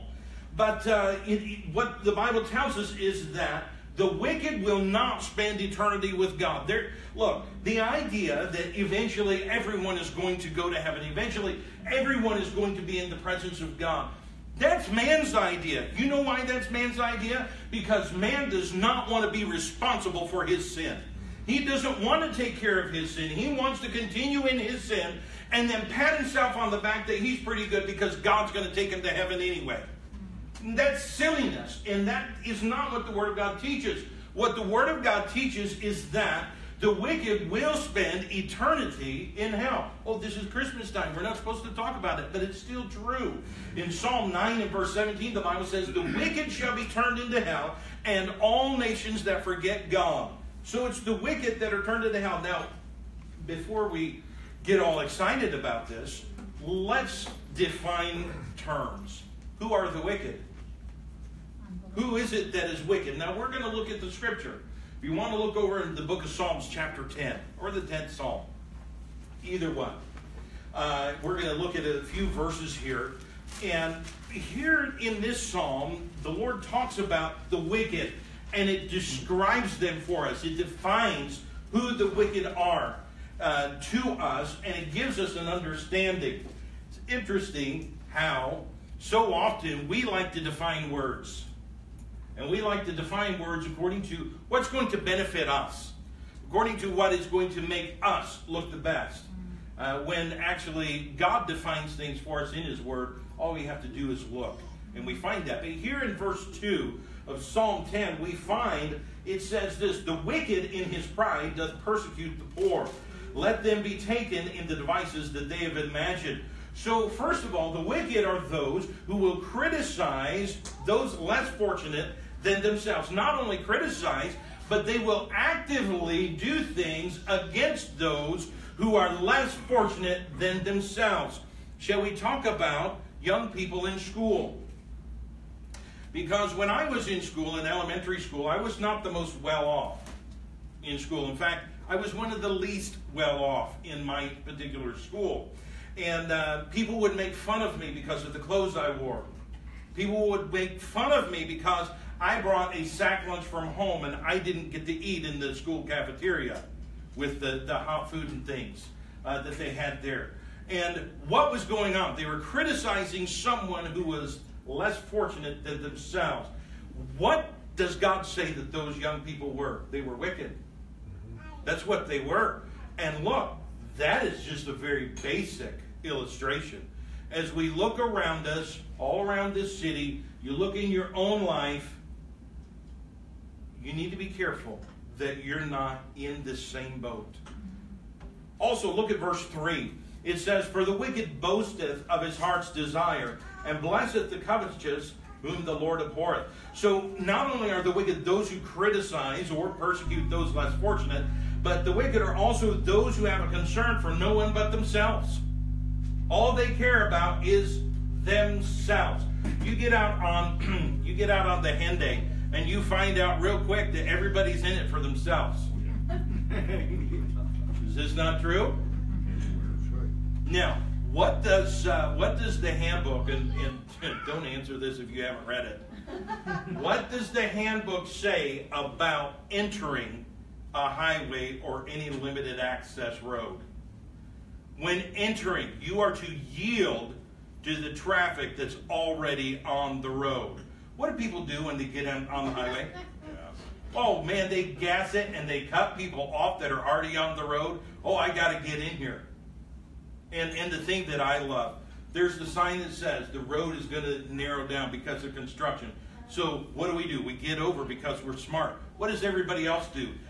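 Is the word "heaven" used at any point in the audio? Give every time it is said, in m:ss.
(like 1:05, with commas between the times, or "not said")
0:10, 0:29.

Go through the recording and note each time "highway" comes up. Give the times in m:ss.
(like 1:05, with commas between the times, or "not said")
3:50, 4:02.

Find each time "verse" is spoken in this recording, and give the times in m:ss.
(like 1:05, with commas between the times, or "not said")
0:44, 1:12, 1:46, 3:09.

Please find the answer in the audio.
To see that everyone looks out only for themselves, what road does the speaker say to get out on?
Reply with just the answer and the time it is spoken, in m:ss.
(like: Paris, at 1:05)
The henday, at 3:31.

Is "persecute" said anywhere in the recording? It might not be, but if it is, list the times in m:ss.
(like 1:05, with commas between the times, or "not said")
1:51, 3:19.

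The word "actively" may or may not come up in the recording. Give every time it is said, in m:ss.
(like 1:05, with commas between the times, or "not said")
2:05.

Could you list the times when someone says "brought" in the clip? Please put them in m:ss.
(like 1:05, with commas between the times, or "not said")
2:32.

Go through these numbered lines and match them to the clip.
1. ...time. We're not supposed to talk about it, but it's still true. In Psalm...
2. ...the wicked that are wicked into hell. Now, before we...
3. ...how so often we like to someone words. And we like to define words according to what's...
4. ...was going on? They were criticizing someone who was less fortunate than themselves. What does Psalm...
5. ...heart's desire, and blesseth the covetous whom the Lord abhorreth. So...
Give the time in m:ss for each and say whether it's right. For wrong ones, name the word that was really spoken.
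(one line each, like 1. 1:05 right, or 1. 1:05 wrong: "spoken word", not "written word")
1. 0:40 right
2. 0:50 wrong: "turned", not "wicked"
3. 1:28 wrong: "define", not "someone"
4. 2:41 wrong: "God", not "Psalm"
5. 3:12 right.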